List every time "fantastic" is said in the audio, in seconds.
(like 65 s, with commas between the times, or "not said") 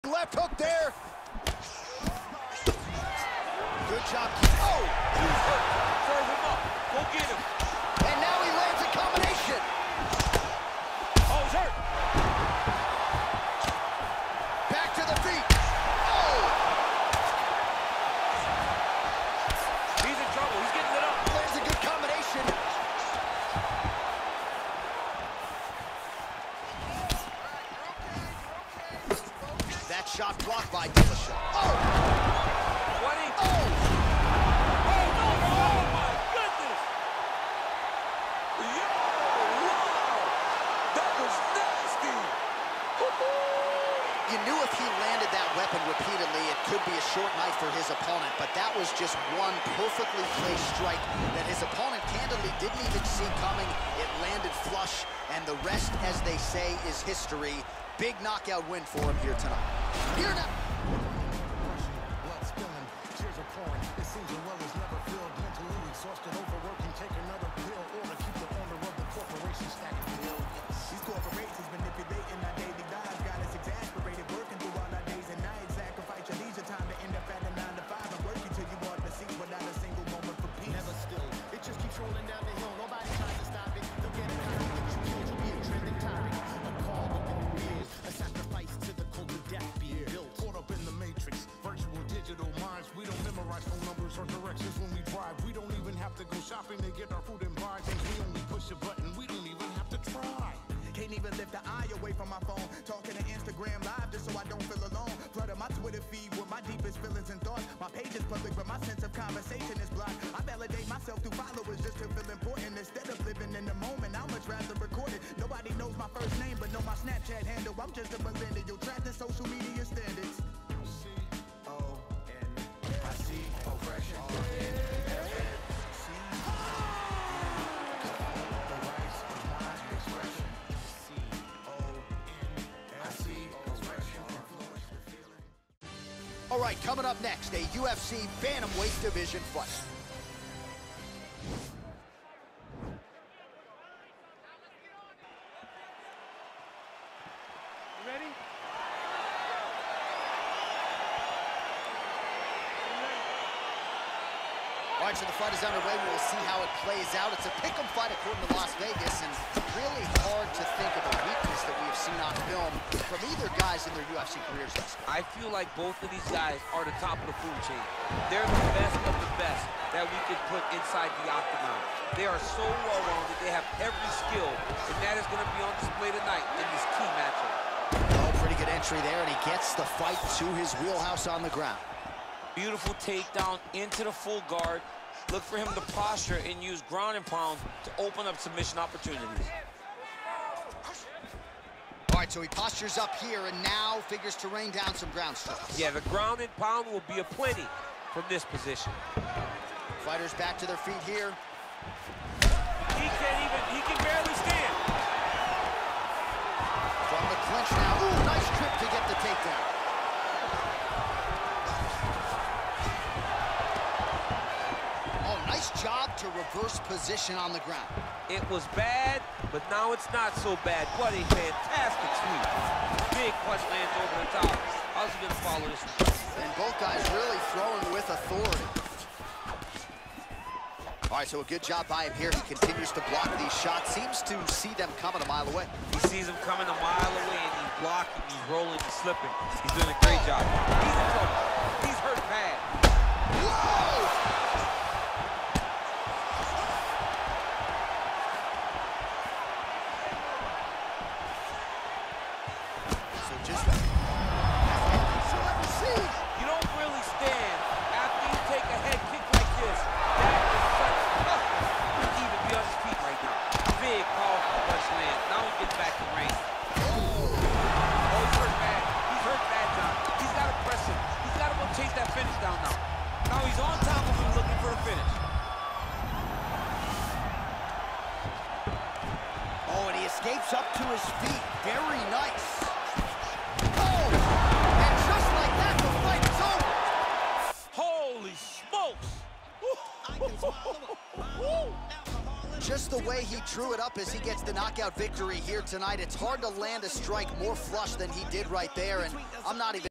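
221 s.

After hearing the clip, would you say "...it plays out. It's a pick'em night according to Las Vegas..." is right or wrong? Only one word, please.
wrong.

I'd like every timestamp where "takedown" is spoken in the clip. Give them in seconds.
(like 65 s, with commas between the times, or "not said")
183 s, 209 s.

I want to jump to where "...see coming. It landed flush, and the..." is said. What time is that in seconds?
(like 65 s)
53 s.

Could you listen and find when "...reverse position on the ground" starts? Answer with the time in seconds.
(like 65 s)
216 s.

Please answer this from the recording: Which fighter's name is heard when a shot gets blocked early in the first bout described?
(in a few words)
Dillashaw.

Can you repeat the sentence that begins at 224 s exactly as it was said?
How's he gonna follow this one?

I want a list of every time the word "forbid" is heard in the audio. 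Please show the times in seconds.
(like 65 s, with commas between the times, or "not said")
not said.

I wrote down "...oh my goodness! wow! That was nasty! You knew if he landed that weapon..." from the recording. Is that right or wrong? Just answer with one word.
right.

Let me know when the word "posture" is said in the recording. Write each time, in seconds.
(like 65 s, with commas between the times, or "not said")
185 s, 192 s.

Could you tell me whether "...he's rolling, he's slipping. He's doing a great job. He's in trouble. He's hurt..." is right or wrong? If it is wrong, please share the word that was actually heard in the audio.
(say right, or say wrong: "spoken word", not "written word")
right.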